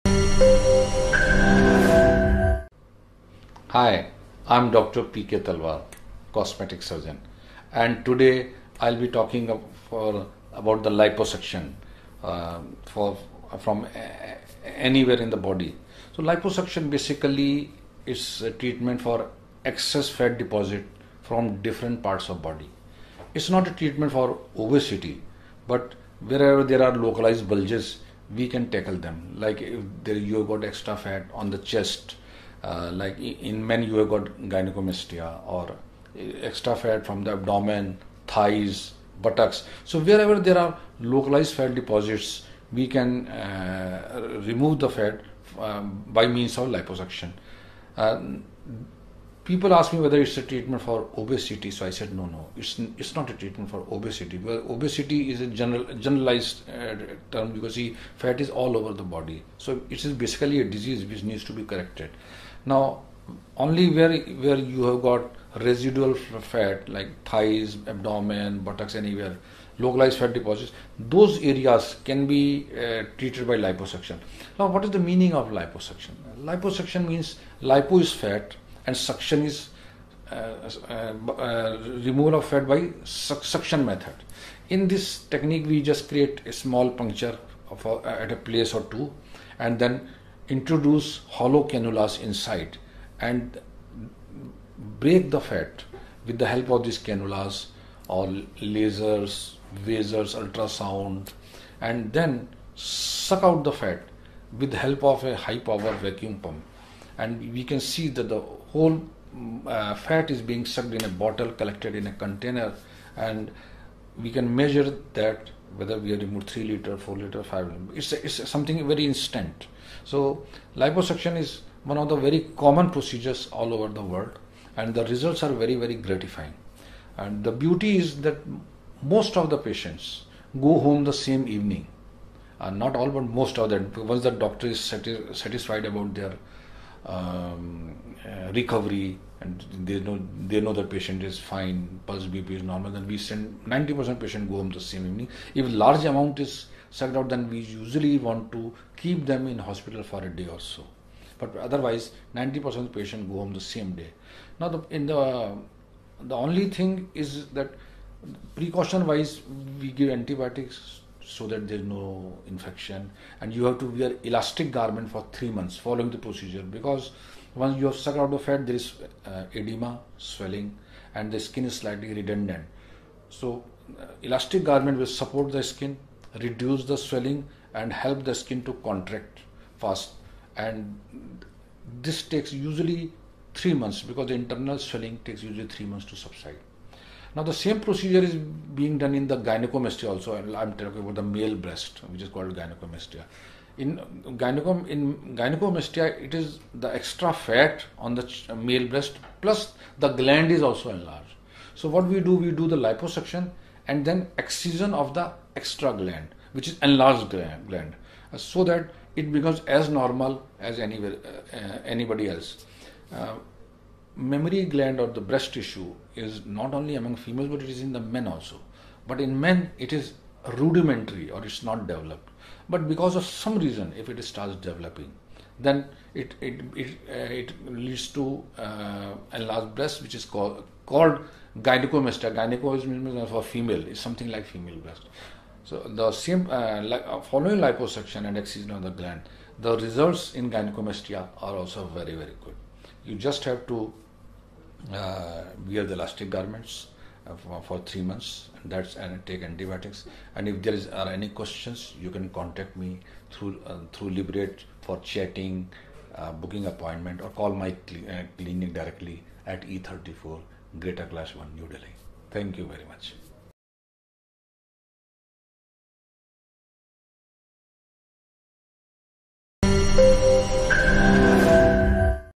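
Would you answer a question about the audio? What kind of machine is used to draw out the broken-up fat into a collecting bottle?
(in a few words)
High power vacuum pump.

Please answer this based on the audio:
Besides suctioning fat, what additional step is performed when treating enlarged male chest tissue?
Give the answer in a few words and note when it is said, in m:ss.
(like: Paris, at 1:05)
Excision of the gland, at 3:24.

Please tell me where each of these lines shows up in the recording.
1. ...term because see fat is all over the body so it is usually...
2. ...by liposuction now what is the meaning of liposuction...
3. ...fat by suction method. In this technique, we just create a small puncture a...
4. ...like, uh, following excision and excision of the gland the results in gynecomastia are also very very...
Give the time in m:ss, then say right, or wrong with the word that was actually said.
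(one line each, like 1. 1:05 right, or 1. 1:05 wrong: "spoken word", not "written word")
1. 0:57 wrong: "basically", not "usually"
2. 1:13 right
3. 1:22 right
4. 3:56 wrong: "liposuction", not "excision".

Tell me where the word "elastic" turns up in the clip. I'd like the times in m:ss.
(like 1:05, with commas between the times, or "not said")
2:44, 2:54, 4:05.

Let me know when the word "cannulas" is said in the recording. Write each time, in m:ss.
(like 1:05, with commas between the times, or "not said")
1:31, 1:36.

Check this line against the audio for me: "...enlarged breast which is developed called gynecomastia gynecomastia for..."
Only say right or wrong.
wrong.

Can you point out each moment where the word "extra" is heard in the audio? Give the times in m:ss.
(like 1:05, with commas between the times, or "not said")
0:30, 0:36, 3:16, 3:25.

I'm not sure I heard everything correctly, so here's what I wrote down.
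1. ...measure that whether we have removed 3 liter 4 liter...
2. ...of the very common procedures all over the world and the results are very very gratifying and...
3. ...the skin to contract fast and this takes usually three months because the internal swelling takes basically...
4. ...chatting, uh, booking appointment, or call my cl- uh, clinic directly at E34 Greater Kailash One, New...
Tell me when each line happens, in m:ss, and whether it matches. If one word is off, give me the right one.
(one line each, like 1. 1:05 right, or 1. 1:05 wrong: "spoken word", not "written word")
1. 1:54 right
2. 2:01 right
3. 2:58 wrong: "usually", not "basically"
4. 4:15 right.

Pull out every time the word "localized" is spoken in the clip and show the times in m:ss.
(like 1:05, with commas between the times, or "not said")
0:26, 0:40, 1:09.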